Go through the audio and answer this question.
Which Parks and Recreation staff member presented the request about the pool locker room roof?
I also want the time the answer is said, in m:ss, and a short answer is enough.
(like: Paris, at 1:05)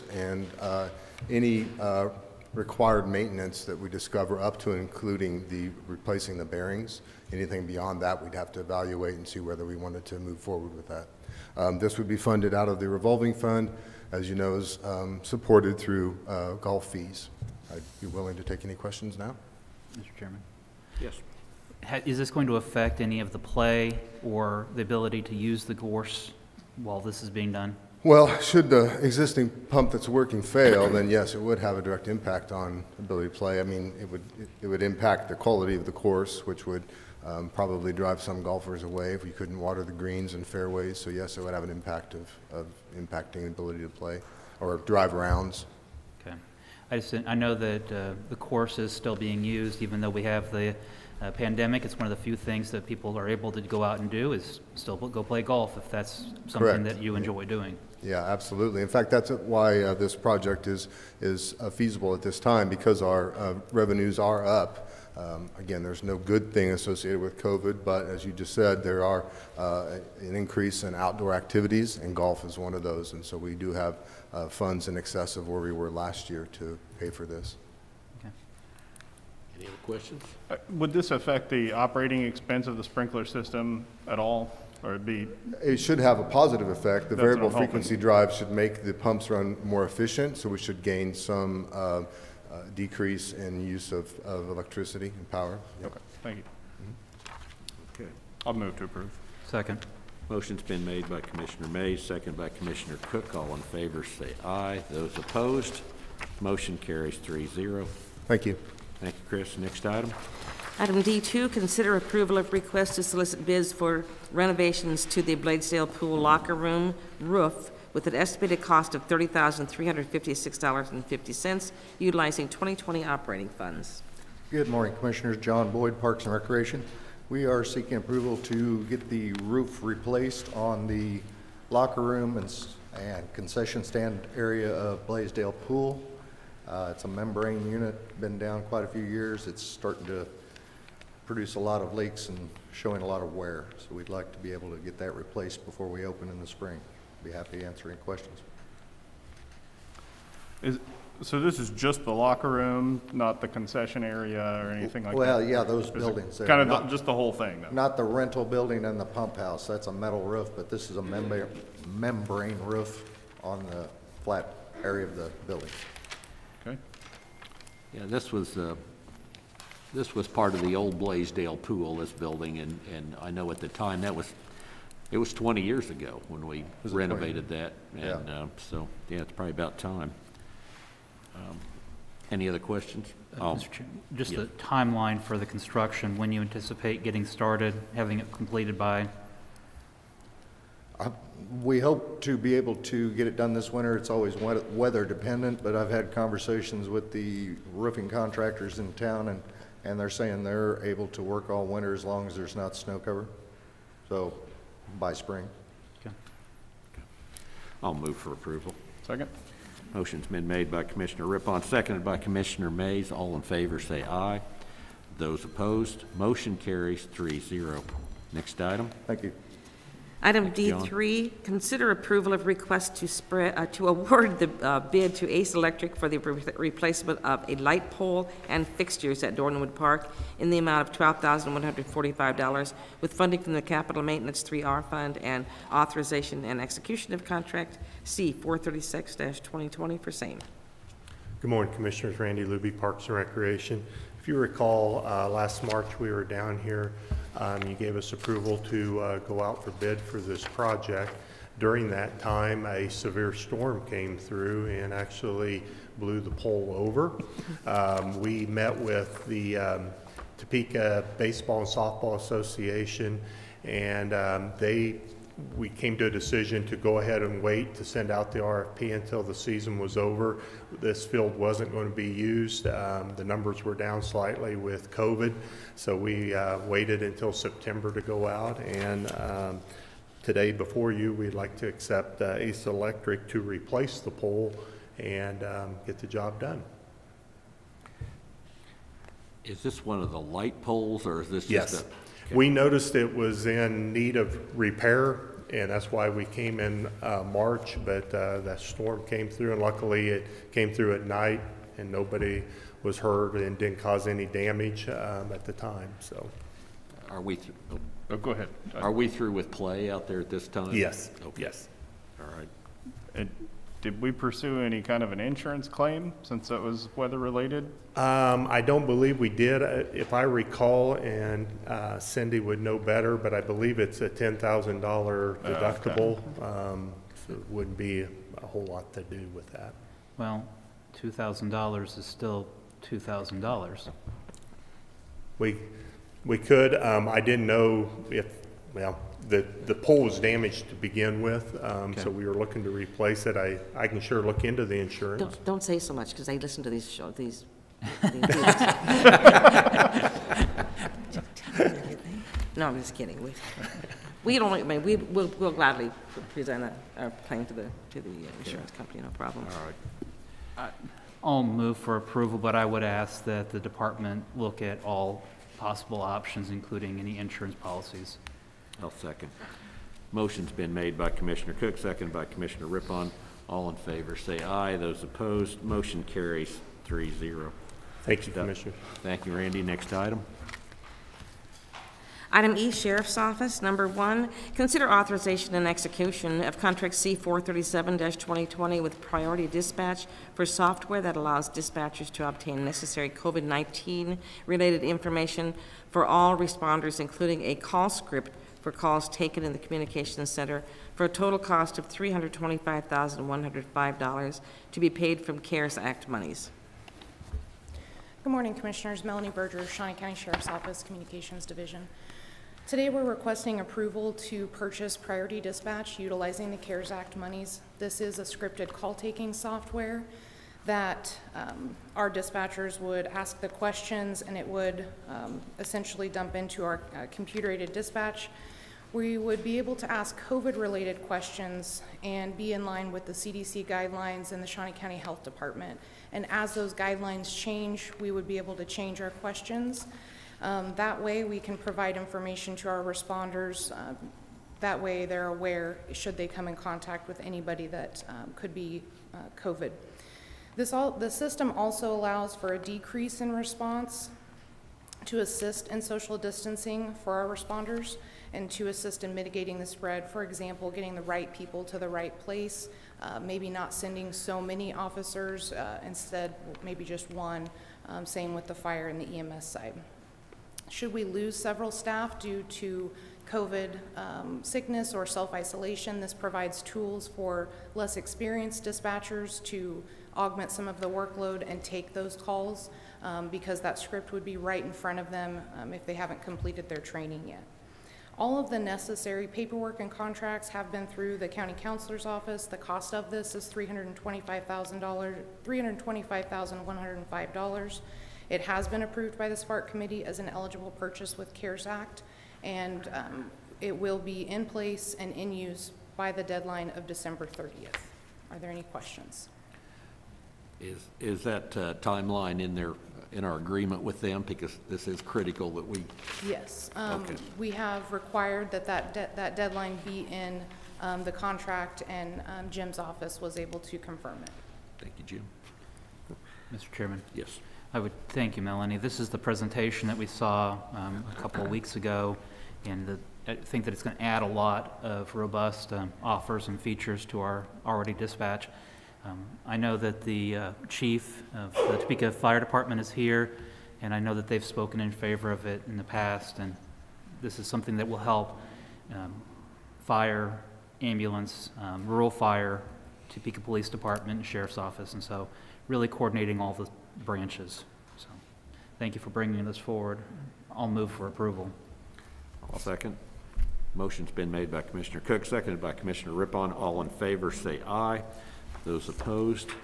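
John Boyd, at 2:05.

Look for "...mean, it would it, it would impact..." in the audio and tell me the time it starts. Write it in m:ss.
0:33.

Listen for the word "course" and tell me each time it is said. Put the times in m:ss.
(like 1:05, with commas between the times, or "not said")
0:35, 0:48.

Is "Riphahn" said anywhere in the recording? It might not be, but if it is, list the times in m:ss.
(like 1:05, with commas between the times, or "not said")
3:31, 6:12, 9:26.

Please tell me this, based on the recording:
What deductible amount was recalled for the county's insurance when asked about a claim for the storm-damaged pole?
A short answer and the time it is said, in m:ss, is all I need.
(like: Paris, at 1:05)
$10,000, at 5:24.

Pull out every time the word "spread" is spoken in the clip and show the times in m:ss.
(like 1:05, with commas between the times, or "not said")
3:43, 7:39.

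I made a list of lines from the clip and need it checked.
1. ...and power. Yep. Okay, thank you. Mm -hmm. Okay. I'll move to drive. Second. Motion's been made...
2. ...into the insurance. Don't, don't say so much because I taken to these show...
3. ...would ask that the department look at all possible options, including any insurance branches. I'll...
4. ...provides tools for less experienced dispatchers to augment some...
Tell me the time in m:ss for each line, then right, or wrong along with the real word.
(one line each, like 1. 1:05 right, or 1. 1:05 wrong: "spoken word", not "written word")
1. 1:35 wrong: "approve", not "drive"
2. 5:44 wrong: "listen", not "taken"
3. 6:02 wrong: "policies", not "branches"
4. 7:56 right.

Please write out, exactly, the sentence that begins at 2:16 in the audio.
Uh, it's a membrane unit, been down quite a few years.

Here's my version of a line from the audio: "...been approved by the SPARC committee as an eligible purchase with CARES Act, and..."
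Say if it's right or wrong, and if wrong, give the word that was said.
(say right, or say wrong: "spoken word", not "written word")
right.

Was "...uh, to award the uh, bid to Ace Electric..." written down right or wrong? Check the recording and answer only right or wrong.
right.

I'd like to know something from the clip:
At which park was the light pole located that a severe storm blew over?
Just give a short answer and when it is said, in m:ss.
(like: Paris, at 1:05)
Dornwood Park, at 3:49.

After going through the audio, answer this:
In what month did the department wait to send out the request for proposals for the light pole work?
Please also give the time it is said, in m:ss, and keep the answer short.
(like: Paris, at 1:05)
September, at 4:37.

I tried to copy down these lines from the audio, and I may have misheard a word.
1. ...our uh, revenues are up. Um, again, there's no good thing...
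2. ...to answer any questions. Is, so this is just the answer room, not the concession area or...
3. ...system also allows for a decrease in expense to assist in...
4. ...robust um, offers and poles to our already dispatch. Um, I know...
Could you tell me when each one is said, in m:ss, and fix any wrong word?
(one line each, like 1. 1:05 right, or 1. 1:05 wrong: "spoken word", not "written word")
1. 1:03 right
2. 2:27 wrong: "locker", not "answer"
3. 7:31 wrong: "response", not "expense"
4. 8:55 wrong: "features", not "poles".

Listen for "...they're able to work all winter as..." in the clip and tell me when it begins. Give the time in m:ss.
3:20.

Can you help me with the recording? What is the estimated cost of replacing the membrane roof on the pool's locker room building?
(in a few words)
$30,356.50.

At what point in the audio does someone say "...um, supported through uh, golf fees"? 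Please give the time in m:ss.
0:14.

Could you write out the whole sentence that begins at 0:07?
Anything beyond that, we'd have to evaluate and see whether we wanted to move forward with that.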